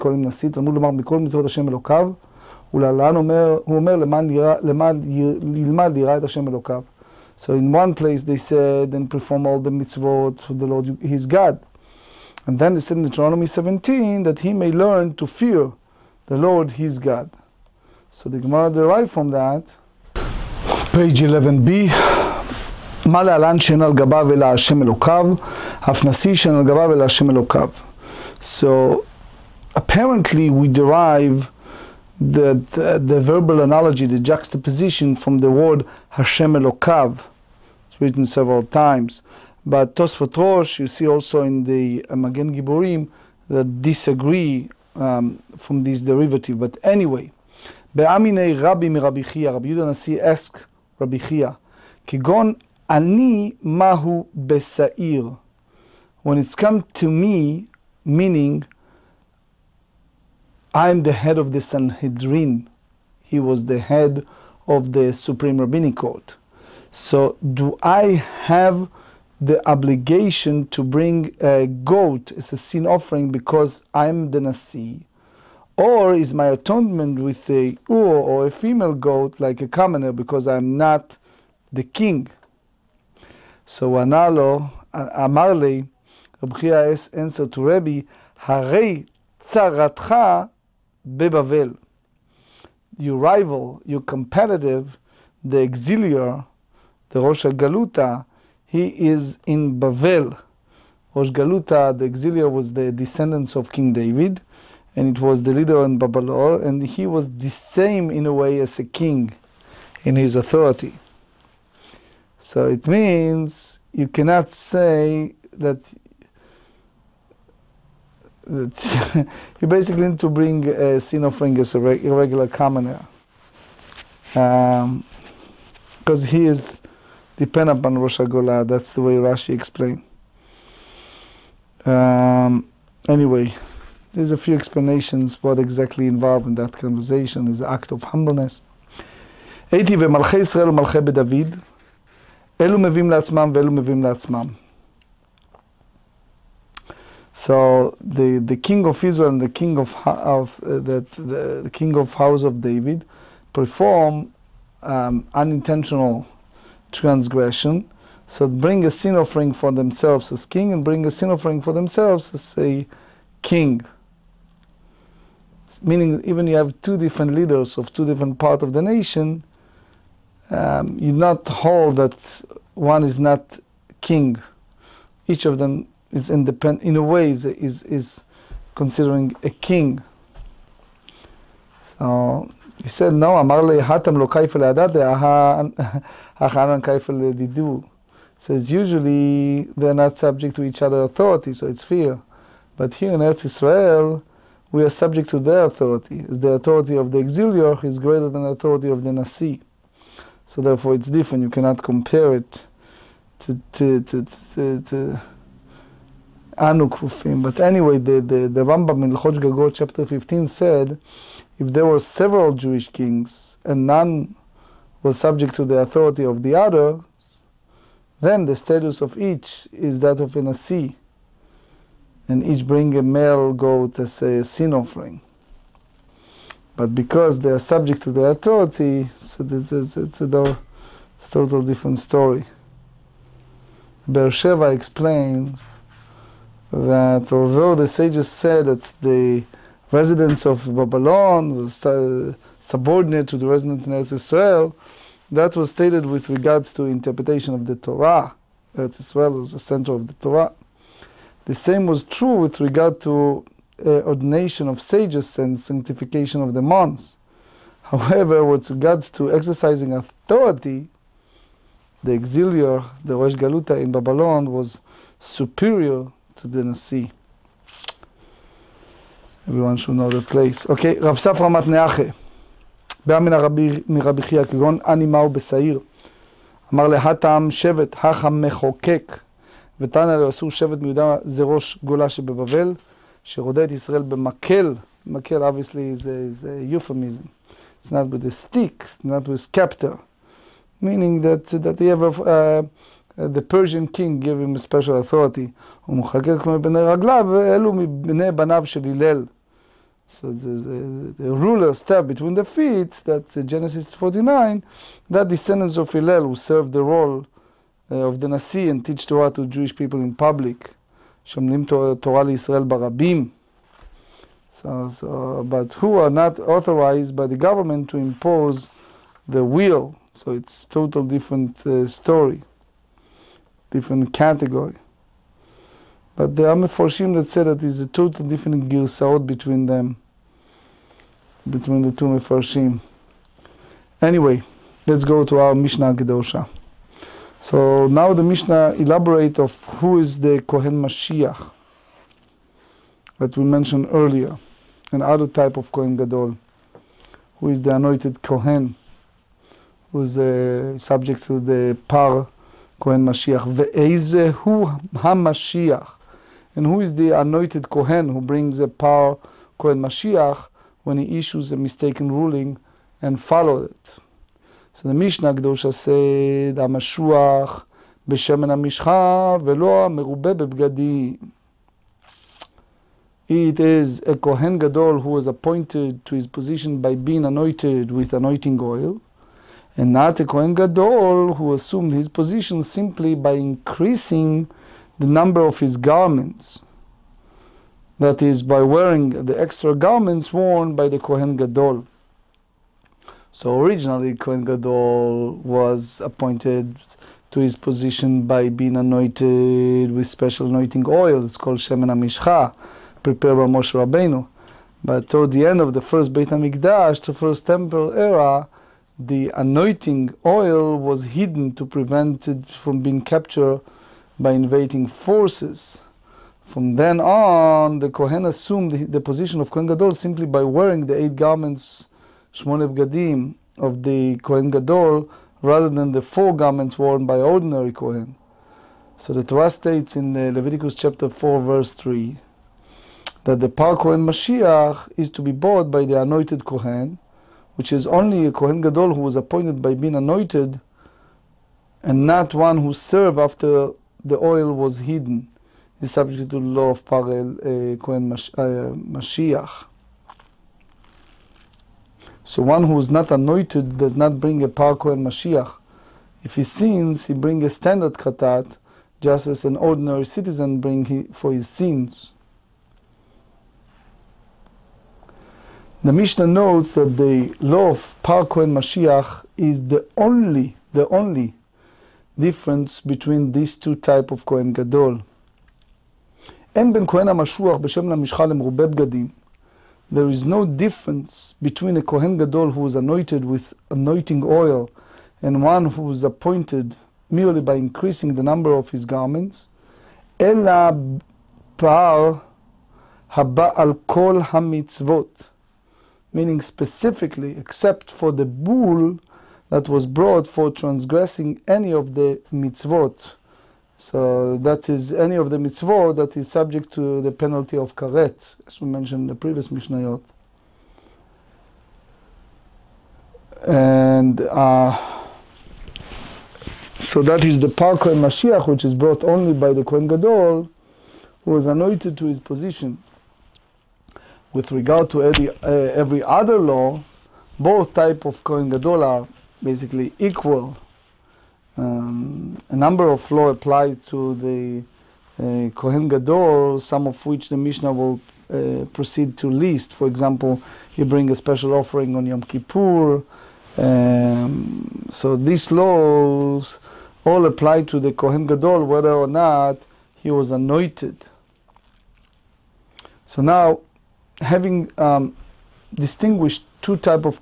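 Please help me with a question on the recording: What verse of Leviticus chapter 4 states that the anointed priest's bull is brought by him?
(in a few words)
Verse 3.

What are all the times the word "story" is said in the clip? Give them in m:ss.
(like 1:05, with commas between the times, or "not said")
3:51, 5:21.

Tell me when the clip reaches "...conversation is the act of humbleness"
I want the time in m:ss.
2:16.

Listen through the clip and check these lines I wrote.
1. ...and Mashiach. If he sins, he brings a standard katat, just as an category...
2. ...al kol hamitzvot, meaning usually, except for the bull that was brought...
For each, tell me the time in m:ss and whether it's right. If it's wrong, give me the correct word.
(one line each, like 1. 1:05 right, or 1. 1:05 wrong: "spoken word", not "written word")
1. 7:34 wrong: "ordinary", not "category"
2. 8:13 wrong: "specifically", not "usually".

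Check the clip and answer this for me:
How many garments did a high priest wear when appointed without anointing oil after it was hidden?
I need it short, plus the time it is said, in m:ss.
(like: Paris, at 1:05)
8, at 7:01.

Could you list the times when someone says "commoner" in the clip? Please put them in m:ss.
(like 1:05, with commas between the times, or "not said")
1:19, 2:02.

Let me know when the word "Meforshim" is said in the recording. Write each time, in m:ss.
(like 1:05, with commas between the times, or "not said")
5:26, 5:32.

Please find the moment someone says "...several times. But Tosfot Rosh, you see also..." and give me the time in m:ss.
0:38.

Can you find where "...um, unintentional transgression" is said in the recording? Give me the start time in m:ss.
2:34.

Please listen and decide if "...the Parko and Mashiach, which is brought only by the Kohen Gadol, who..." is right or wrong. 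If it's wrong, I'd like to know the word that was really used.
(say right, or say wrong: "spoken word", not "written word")
right.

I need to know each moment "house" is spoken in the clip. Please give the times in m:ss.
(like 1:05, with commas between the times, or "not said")
2:32.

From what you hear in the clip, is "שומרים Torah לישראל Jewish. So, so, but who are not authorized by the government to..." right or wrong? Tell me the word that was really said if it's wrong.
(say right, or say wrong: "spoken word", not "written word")
wrong: "Barabim", not "Jewish".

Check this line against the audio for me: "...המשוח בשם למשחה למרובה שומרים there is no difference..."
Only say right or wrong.
wrong.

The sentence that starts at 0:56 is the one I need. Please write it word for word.
When it's come to me, meaning I'm the head of the Sanhedrin.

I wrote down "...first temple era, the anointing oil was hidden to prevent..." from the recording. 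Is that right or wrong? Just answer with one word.
right.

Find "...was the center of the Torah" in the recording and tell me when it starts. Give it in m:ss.
4:09.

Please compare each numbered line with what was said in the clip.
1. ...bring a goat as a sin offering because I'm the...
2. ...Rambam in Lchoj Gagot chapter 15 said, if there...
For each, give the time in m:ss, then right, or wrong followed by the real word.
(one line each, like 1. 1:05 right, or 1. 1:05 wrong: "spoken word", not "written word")
1. 1:10 right
2. 3:28 right.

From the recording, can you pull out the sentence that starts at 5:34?
Anyway, let's go to our Mishnah Gedosha.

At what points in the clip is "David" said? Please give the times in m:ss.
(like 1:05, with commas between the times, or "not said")
1:43, 2:32.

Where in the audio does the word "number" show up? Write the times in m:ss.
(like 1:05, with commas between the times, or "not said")
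6:25, 8:08, 8:52.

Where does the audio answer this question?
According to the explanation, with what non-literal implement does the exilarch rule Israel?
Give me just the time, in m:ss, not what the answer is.
4:44.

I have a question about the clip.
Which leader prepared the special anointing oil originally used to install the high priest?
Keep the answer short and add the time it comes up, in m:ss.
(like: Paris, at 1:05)
Moshe Rabbeinu, at 6:43.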